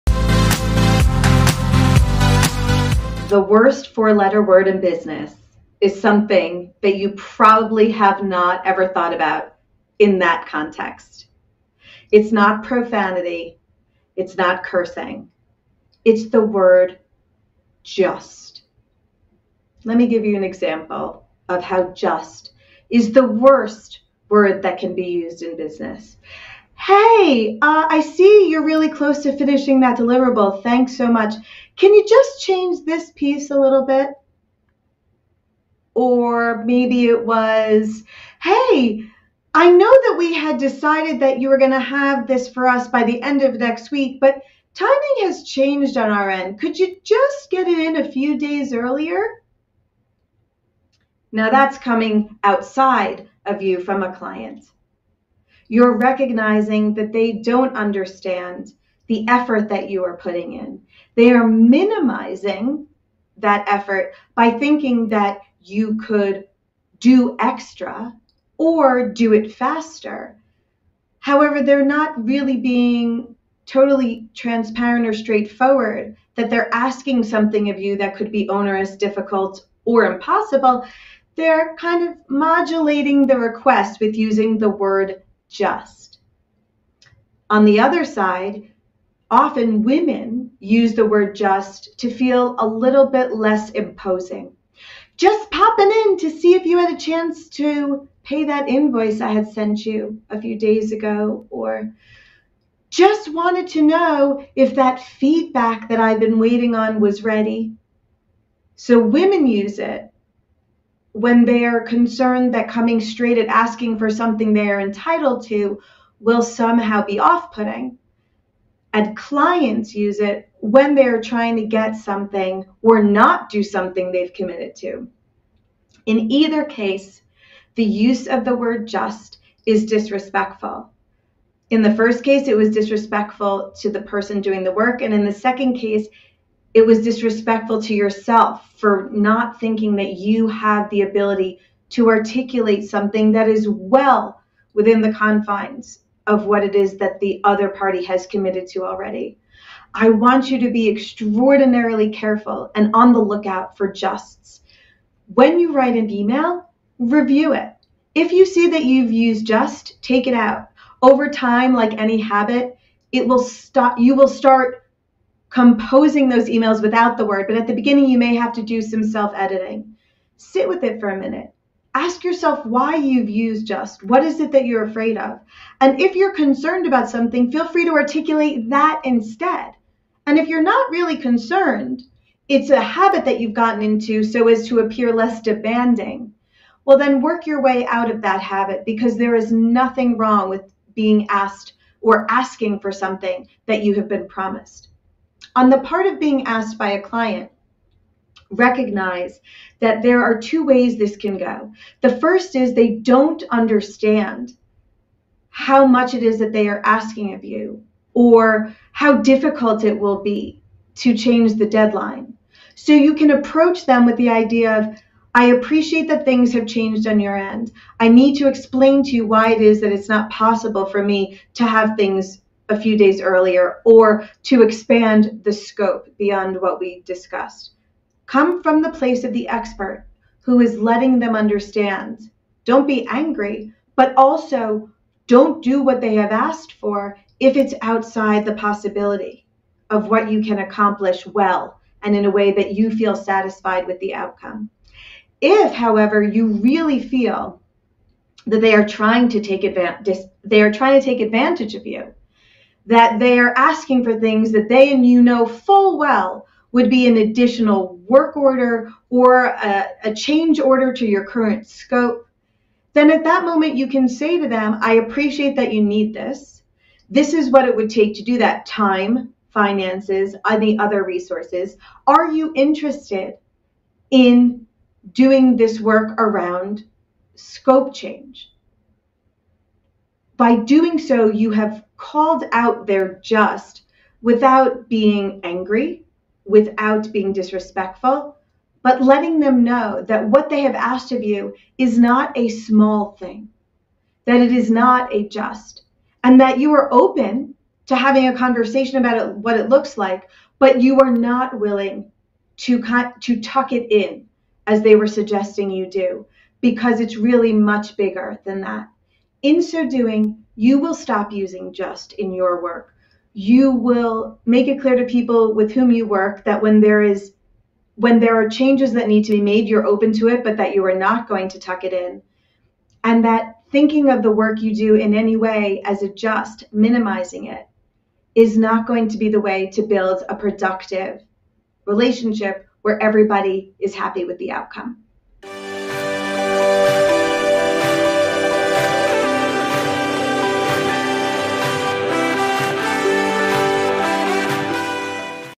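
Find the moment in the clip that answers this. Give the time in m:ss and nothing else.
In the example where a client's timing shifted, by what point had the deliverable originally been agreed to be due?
0:43.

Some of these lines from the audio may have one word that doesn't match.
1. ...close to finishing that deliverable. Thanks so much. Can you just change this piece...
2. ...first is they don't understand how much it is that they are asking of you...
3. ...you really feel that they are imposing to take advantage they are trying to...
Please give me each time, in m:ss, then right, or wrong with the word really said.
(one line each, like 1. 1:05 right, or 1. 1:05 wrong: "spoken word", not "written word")
1. 0:28 right
2. 3:22 right
3. 4:06 wrong: "trying", not "imposing".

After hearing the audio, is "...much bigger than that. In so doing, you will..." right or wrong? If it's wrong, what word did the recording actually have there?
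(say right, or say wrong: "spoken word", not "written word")
right.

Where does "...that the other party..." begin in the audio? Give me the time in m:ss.
2:26.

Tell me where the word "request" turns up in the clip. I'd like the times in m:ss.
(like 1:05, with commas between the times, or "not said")
1:23.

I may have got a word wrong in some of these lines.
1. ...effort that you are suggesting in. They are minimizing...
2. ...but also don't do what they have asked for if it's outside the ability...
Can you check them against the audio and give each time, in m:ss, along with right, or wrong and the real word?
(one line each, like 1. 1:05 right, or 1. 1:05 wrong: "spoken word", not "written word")
1. 0:59 wrong: "putting", not "suggesting"
2. 3:53 wrong: "possibility", not "ability".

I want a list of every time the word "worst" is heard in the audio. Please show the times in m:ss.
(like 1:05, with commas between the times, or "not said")
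0:03, 0:23.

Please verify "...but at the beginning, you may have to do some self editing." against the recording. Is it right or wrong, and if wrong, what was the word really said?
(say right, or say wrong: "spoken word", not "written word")
right.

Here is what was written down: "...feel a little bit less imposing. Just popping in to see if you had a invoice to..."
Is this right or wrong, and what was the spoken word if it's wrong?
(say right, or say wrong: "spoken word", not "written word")
wrong: "chance", not "invoice".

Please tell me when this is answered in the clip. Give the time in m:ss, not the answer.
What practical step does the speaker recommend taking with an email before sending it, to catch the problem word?
2:36.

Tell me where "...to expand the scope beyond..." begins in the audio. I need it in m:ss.
3:44.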